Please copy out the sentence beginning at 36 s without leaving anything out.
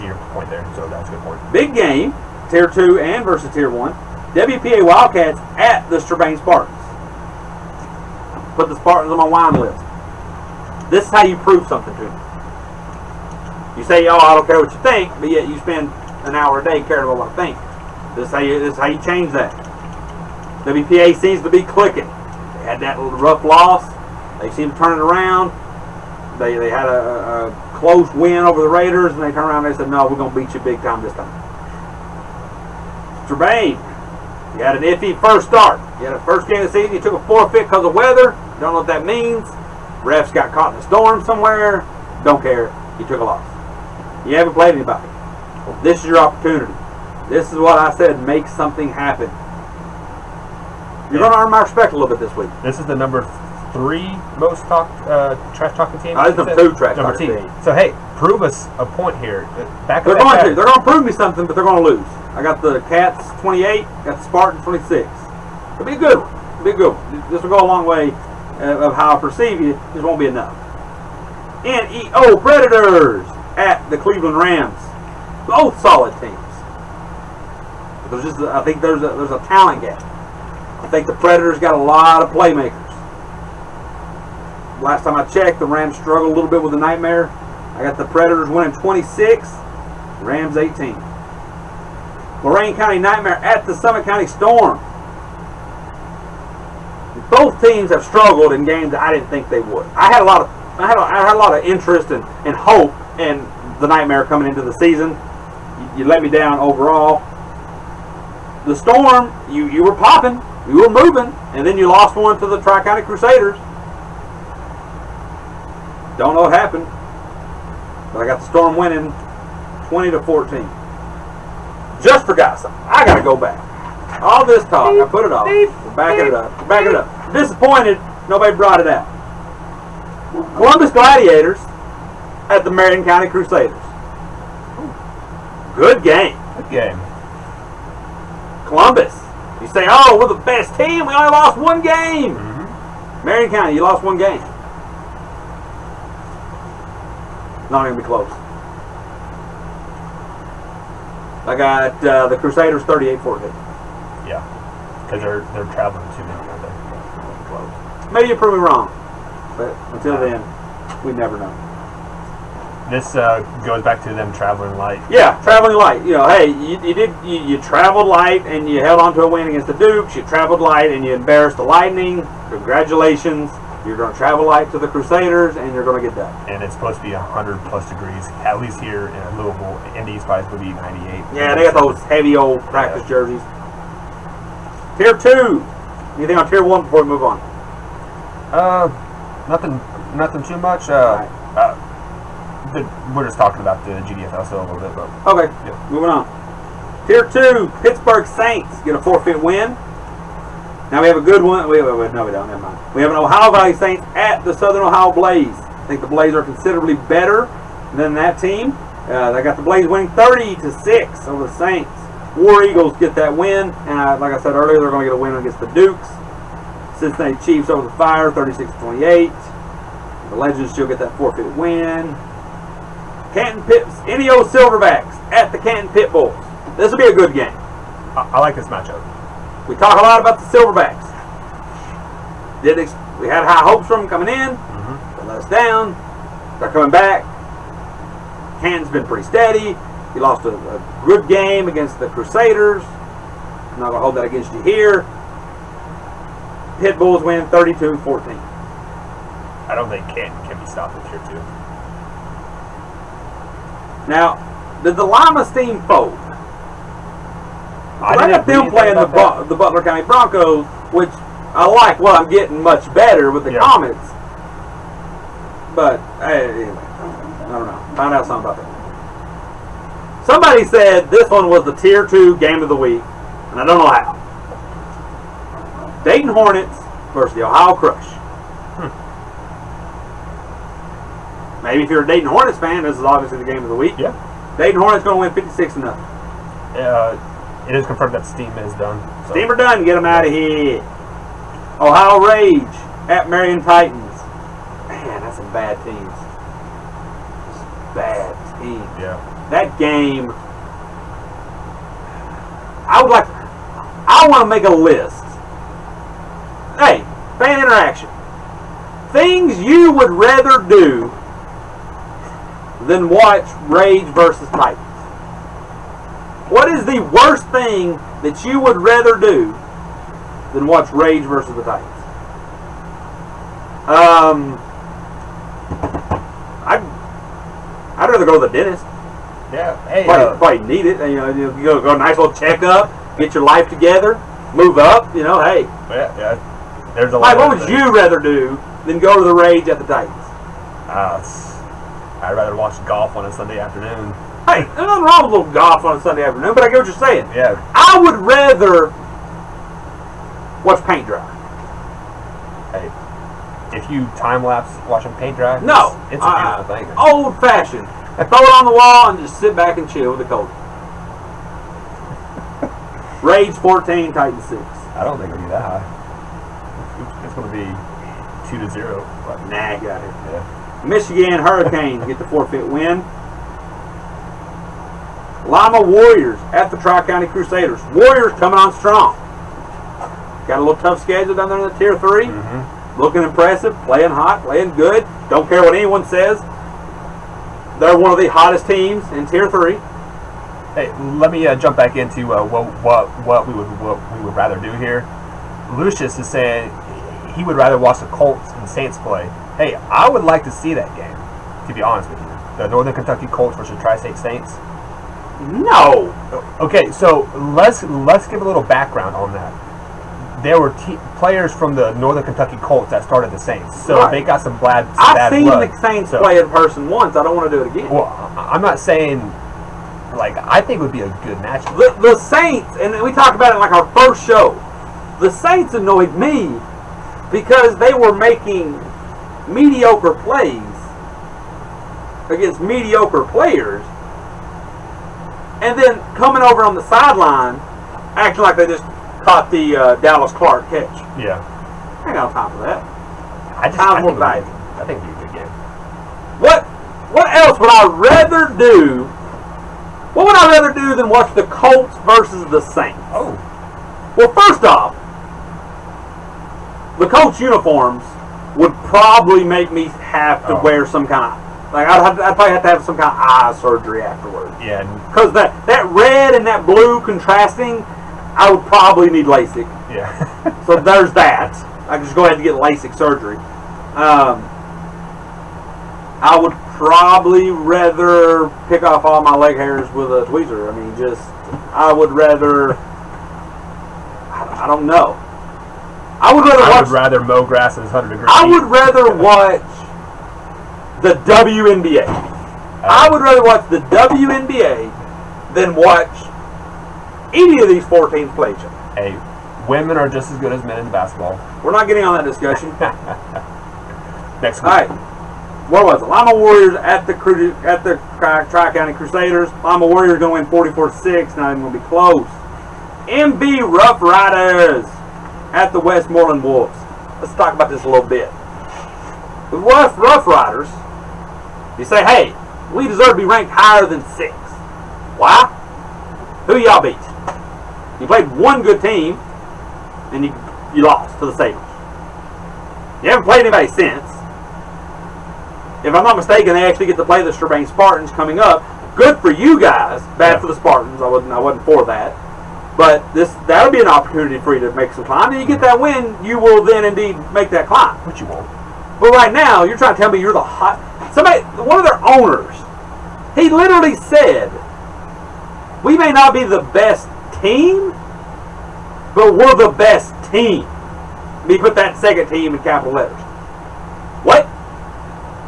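You had a first game of the season.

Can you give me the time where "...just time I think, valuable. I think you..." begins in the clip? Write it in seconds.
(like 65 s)
443 s.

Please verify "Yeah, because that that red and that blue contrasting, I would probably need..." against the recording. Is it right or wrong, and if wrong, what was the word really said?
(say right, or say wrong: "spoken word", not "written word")
right.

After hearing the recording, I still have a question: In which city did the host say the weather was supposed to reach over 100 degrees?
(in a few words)
Louisville.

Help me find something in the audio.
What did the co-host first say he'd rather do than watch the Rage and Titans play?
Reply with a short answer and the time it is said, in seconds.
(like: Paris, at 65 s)
go to the dentist, at 328 s.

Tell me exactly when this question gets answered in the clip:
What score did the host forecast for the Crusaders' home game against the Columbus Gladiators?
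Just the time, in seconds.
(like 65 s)
152 s.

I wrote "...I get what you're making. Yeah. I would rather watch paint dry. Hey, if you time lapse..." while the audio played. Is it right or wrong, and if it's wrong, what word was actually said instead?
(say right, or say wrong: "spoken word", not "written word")
wrong: "saying", not "making".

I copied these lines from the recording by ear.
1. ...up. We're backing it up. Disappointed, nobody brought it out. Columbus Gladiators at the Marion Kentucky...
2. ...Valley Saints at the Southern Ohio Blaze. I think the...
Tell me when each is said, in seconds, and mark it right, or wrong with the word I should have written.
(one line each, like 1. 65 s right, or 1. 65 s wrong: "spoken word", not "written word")
1. 126 s wrong: "County", not "Kentucky"
2. 203 s right.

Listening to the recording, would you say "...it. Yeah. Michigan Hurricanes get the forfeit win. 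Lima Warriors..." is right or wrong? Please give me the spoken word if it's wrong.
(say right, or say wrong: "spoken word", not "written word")
right.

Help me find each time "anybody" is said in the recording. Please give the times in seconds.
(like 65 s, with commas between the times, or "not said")
44 s, 533 s.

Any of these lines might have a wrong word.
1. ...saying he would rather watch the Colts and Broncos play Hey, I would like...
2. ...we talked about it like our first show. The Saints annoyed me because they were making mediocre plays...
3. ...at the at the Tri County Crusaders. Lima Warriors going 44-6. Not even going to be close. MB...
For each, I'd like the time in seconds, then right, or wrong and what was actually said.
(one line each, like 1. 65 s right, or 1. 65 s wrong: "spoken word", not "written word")
1. 396 s wrong: "Saints", not "Broncos"
2. 423 s right
3. 506 s right.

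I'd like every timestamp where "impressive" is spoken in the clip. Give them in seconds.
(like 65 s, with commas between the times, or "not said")
383 s.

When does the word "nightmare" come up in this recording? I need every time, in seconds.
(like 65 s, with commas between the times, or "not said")
86 s, 92 s, 103 s.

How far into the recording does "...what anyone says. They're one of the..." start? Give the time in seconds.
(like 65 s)
385 s.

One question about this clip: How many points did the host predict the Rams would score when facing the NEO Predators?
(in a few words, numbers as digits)
18.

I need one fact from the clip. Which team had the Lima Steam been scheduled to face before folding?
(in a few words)
Butler County Broncos.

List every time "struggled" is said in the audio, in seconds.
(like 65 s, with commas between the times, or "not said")
85 s, 98 s.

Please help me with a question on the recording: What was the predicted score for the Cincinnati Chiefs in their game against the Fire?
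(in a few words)
36-28.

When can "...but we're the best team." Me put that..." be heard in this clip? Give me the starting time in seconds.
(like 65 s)
559 s.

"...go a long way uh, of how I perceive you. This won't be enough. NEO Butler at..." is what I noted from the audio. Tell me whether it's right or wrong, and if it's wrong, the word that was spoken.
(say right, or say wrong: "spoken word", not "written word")
wrong: "Predators", not "Butler".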